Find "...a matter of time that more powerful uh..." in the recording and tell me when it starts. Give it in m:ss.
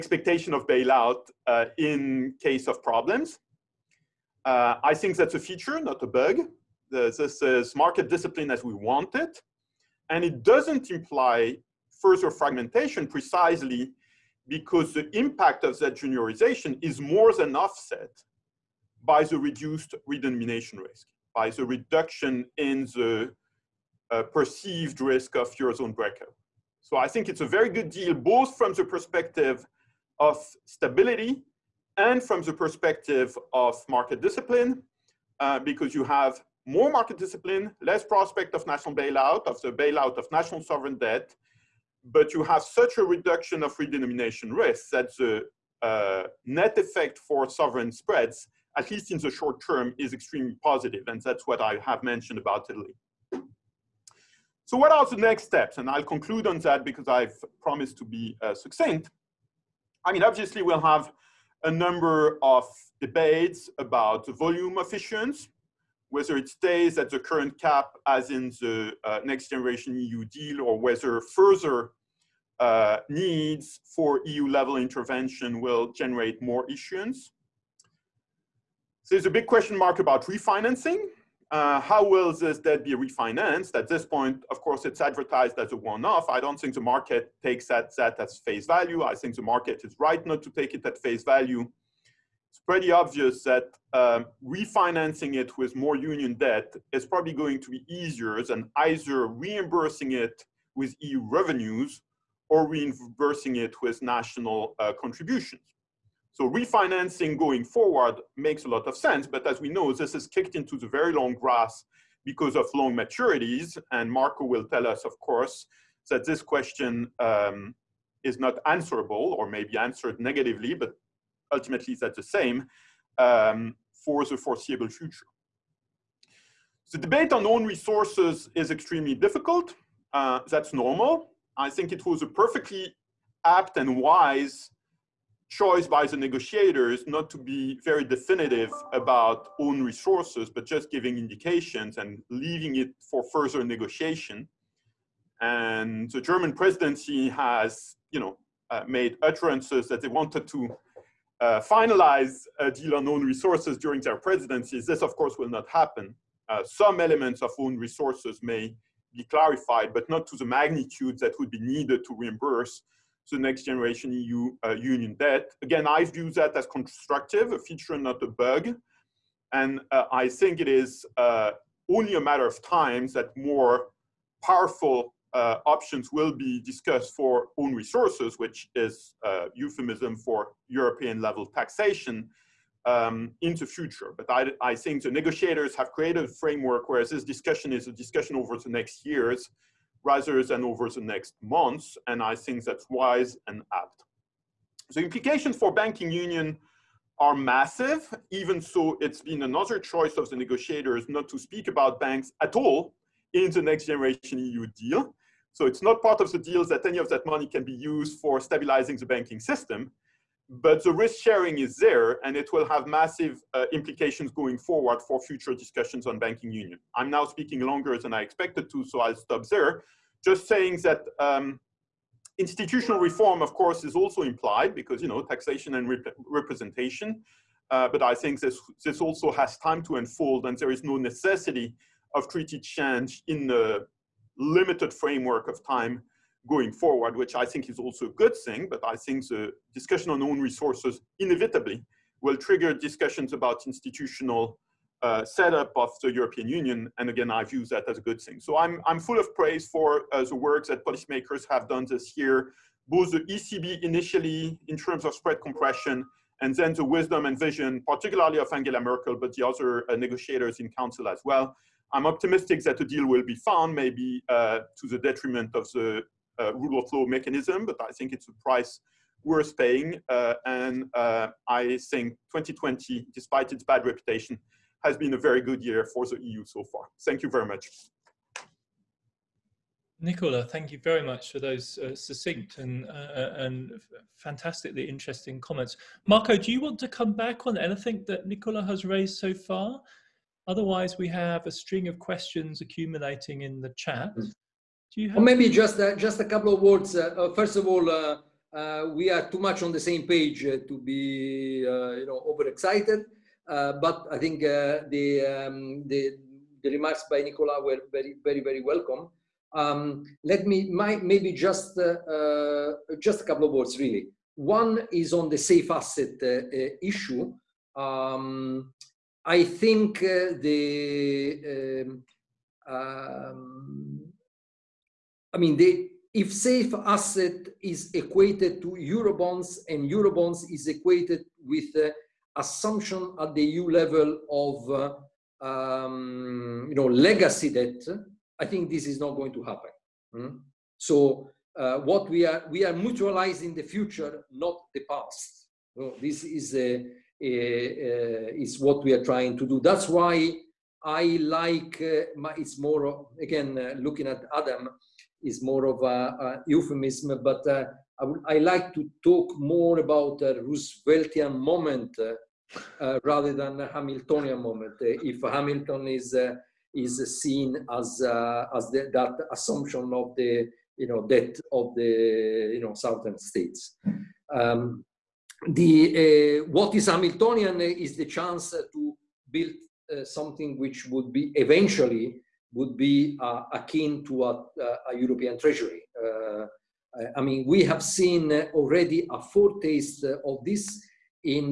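2:52.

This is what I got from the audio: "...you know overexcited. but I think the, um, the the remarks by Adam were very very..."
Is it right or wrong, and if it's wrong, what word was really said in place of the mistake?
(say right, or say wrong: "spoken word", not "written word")
wrong: "Nicolas", not "Adam".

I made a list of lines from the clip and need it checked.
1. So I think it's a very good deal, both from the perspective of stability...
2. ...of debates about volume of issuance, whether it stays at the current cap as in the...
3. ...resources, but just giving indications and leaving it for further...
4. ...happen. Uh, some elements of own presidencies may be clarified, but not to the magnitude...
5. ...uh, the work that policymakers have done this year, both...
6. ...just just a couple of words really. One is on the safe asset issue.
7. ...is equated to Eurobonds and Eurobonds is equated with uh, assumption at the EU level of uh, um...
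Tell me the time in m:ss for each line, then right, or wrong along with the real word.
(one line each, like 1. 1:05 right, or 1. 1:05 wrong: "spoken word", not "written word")
1. 0:26 right
2. 1:02 right
3. 2:19 right
4. 2:35 wrong: "resources", not "presidencies"
5. 4:10 right
6. 5:11 right
7. 5:27 right.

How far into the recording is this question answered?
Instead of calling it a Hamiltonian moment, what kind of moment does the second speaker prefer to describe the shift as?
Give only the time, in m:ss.
6:00.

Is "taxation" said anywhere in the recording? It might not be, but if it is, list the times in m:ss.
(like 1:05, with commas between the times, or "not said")
3:01, 3:45.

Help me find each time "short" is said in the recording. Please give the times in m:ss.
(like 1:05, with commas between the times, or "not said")
0:49.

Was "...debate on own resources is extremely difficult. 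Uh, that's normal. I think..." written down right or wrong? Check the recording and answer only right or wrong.
right.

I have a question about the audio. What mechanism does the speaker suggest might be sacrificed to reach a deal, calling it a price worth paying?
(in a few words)
Rule of law mechanism.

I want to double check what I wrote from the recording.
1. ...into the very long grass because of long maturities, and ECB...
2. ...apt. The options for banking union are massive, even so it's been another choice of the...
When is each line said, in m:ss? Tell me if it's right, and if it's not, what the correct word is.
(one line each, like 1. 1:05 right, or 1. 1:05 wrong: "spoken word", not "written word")
1. 1:50 wrong: "Marco", not "ECB"
2. 3:13 wrong: "implications", not "options".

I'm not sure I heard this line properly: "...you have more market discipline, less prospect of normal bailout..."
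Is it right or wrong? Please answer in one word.
wrong.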